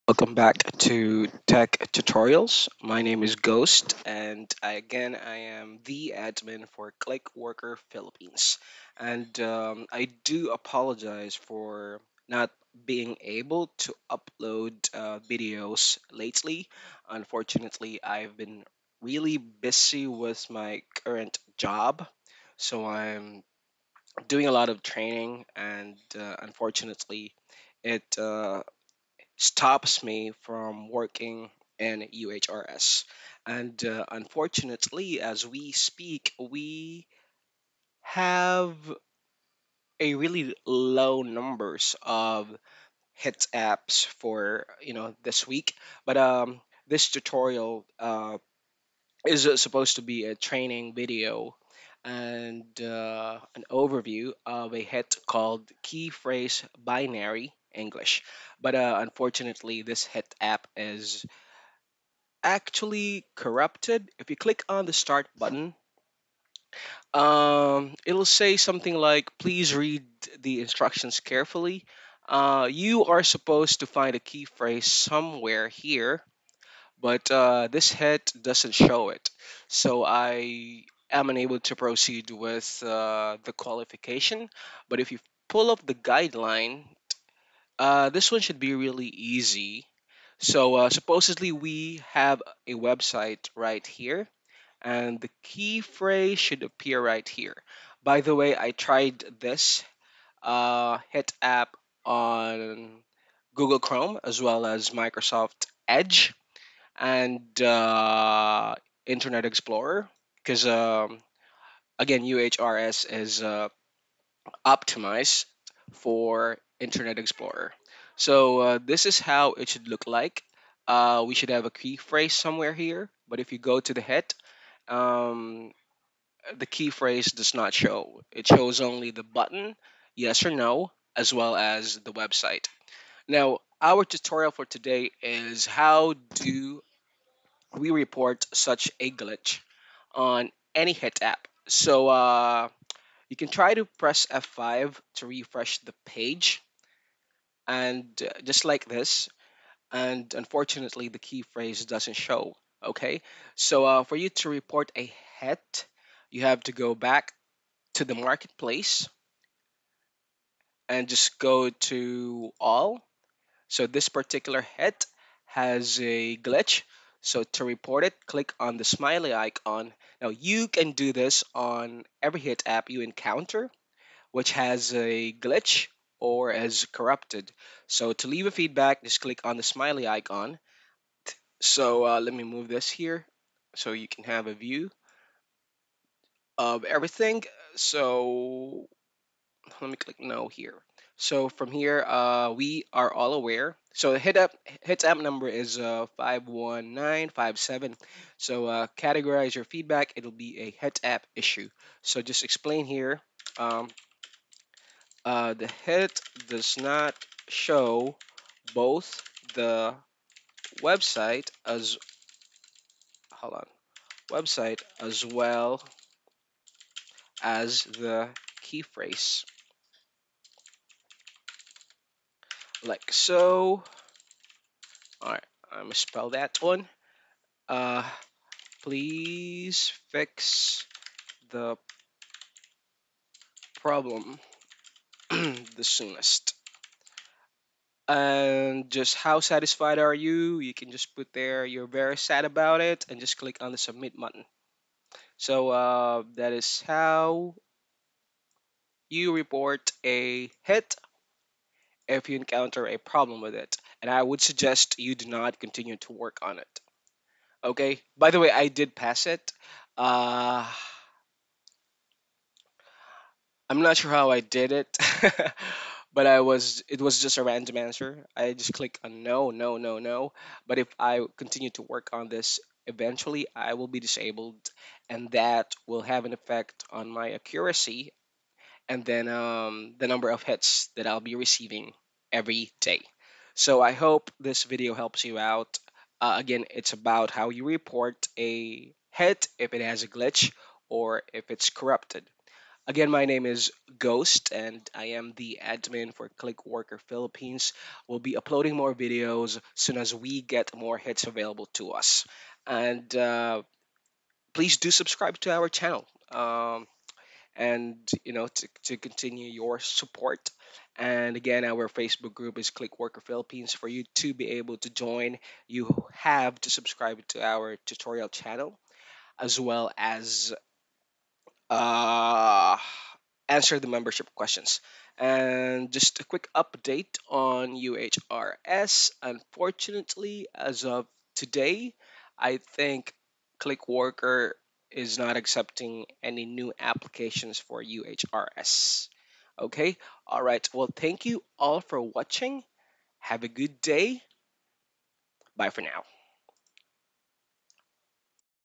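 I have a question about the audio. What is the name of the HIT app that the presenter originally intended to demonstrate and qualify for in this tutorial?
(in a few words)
Key phrase binary English.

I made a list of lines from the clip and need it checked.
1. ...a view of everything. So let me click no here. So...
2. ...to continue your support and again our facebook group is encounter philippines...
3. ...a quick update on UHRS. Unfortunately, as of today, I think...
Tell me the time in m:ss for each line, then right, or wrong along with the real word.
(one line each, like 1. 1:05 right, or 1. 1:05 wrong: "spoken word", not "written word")
1. 3:04 right
2. 5:08 wrong: "clickworker", not "encounter"
3. 5:26 right.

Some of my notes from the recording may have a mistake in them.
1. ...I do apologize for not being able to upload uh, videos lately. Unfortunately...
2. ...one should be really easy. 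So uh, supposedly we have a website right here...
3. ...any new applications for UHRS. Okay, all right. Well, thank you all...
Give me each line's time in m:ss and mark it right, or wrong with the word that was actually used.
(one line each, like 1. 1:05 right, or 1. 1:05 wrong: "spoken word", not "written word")
1. 0:09 right
2. 1:28 right
3. 5:36 right.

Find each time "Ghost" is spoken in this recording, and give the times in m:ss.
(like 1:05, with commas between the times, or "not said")
0:03, 4:53.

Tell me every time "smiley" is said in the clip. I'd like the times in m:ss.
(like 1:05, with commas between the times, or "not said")
2:48, 2:59.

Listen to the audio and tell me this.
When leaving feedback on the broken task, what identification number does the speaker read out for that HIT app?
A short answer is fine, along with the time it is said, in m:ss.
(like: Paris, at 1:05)
51957, at 3:16.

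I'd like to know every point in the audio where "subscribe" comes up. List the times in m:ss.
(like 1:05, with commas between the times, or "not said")
5:04, 5:16.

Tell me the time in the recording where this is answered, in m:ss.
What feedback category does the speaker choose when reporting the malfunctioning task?
3:20.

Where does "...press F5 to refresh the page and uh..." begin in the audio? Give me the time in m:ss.
2:23.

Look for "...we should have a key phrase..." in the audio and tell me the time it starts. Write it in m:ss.
2:01.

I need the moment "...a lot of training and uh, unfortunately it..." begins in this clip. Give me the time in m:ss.
0:24.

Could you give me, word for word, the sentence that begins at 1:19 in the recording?
So I am unable to proceed with uh, the qualification.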